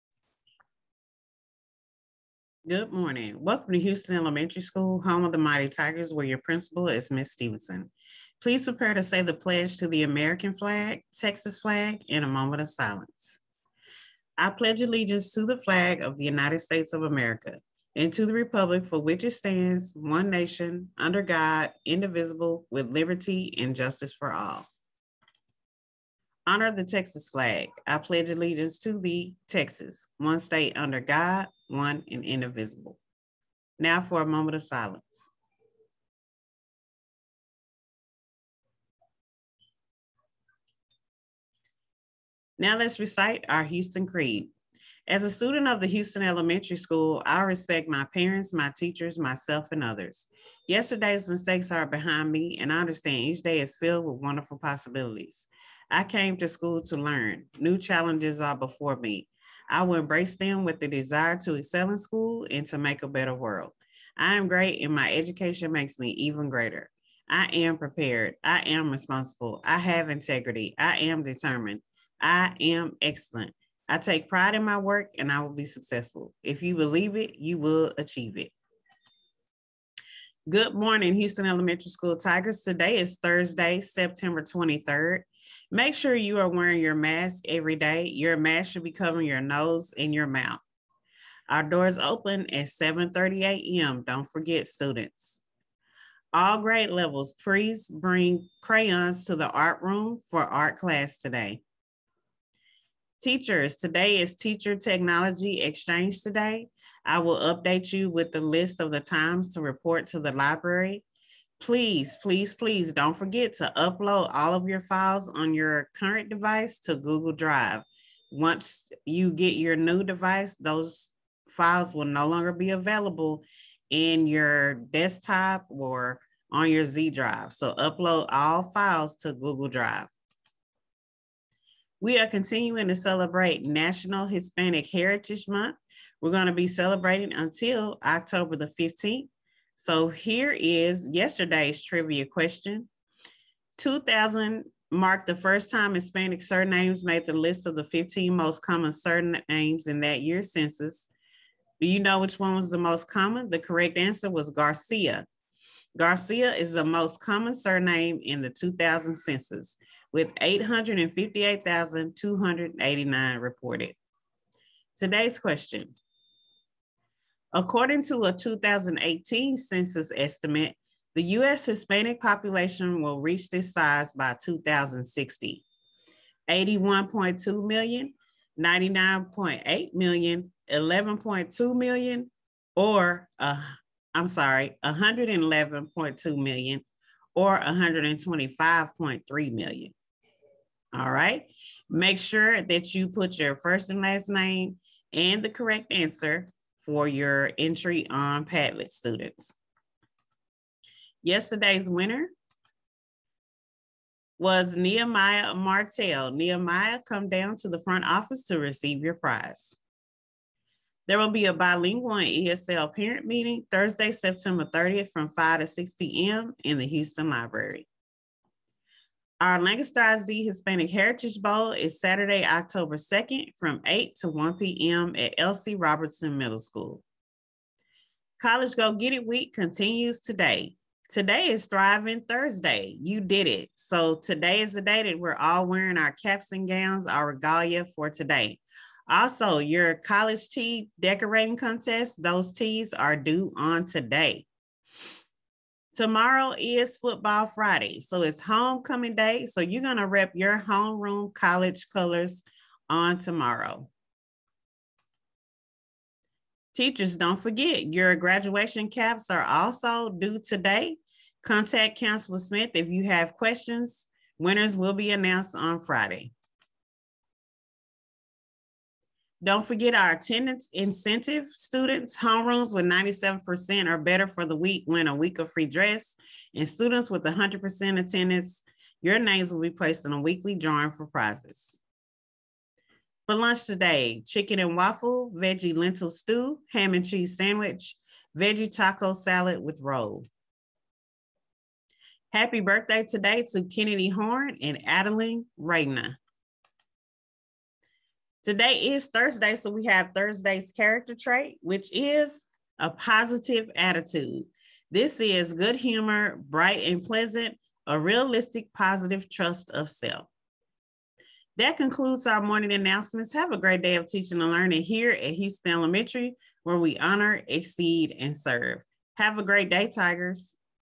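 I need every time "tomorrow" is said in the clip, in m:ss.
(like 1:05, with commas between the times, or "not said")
4:06, 4:13.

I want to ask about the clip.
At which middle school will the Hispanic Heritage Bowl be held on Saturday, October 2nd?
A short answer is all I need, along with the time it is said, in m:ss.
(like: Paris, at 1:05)
Elsie Robertson Middle School, at 3:45.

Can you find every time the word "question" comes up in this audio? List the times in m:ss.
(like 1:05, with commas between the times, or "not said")
2:22, 2:45, 4:23.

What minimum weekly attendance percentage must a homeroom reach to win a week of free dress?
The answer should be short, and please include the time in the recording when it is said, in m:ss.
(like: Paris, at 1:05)
97%, at 4:32.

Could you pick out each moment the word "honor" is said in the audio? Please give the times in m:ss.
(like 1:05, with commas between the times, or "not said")
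0:26, 5:16.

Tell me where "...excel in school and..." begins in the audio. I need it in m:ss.
1:01.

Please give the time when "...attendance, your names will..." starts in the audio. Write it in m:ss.
4:37.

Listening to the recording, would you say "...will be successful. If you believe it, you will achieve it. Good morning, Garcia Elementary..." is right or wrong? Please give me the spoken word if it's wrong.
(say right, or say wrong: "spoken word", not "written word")
wrong: "Houston", not "Garcia".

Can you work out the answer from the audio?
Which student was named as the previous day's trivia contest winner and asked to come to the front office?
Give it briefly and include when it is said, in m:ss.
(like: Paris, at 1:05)
Nehemiah Martell, at 3:24.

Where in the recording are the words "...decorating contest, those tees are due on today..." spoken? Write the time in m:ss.
4:00.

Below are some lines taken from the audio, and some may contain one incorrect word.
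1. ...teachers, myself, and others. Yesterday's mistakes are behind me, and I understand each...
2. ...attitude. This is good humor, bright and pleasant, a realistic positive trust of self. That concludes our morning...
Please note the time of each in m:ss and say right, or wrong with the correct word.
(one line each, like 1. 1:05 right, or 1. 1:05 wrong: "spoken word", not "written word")
1. 0:48 right
2. 5:03 right.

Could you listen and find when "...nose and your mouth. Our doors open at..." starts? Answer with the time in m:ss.
1:29.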